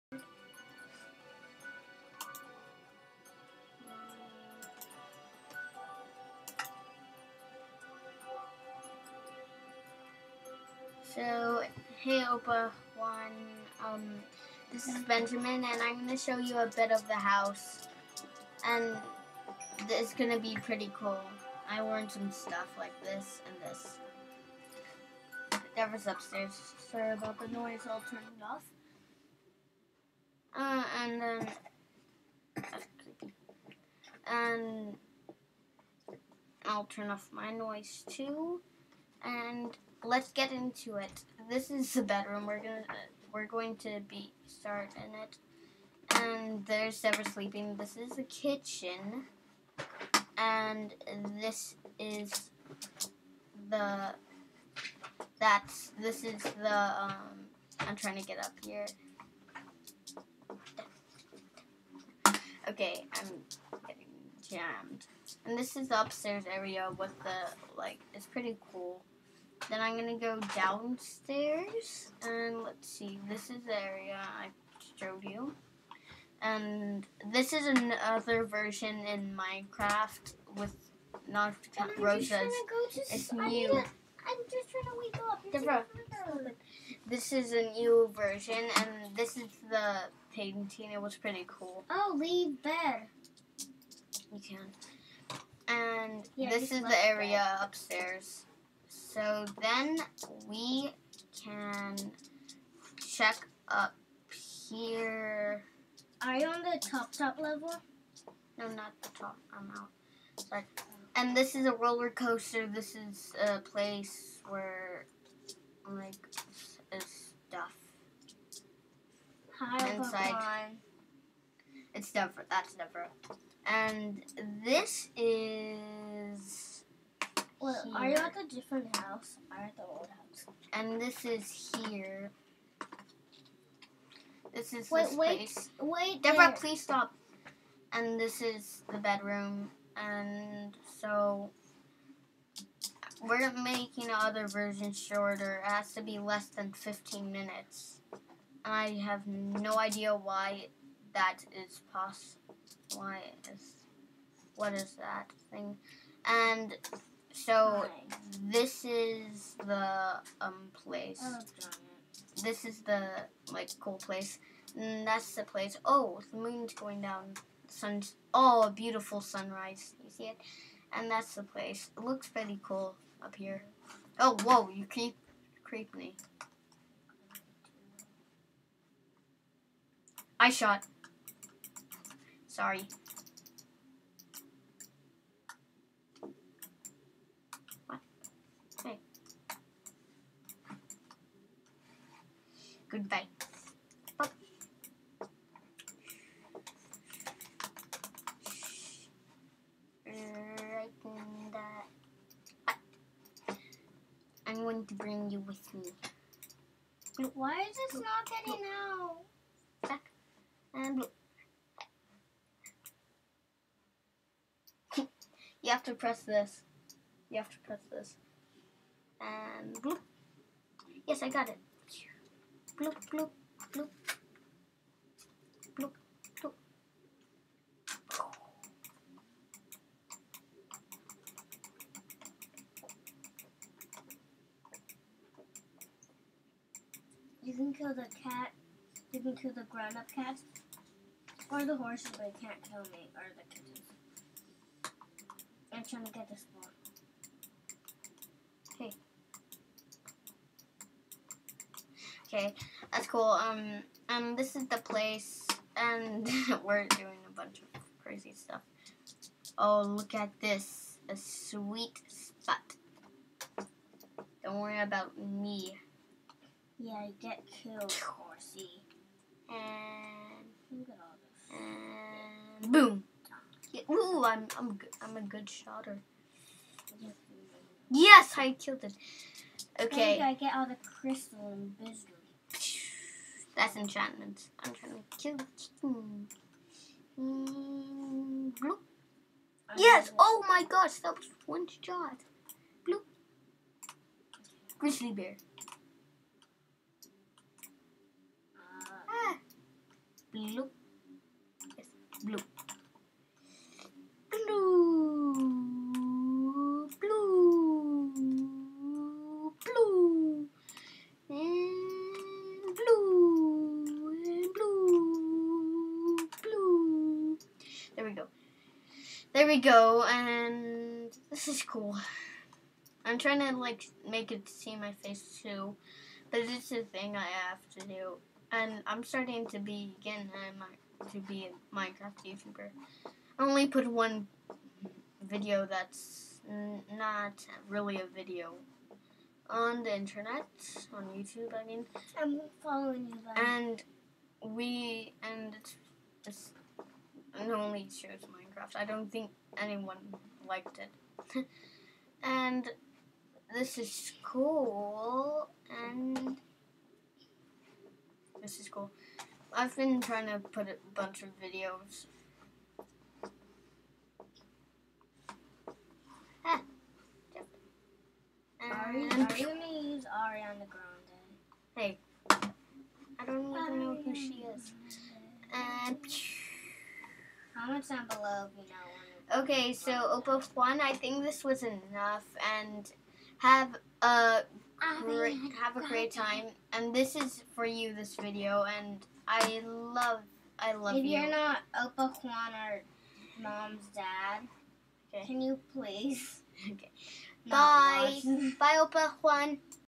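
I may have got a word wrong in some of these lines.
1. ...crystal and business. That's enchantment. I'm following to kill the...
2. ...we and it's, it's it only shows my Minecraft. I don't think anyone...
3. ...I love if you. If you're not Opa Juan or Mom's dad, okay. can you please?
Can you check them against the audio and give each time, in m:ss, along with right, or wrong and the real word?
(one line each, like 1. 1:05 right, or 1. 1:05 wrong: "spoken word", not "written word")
1. 4:40 wrong: "trying", not "following"
2. 5:44 right
3. 6:30 right.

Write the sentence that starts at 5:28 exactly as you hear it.
And I'm starting to be again to be a Minecraft YouTuber.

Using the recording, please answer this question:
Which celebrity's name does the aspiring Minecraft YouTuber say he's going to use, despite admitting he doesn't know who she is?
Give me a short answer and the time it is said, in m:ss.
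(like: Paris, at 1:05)
Ariana Grande, at 6:10.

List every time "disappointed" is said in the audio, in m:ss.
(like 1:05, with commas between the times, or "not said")
not said.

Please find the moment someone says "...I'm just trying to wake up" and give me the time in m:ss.
1:23.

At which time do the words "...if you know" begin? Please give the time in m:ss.
6:18.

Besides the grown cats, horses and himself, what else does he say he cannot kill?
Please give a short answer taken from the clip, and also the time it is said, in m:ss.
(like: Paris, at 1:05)
the kittens, at 4:03.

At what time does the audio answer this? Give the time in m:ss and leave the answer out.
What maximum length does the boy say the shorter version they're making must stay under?
2:26.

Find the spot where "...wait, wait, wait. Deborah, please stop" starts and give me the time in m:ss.
2:14.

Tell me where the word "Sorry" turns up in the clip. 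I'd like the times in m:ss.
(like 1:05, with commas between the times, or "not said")
0:26, 1:50, 3:02.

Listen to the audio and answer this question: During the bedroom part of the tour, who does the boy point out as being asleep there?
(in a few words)
Sever.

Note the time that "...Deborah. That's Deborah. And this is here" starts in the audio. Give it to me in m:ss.
2:02.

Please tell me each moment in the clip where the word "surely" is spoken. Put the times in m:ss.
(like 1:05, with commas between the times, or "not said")
not said.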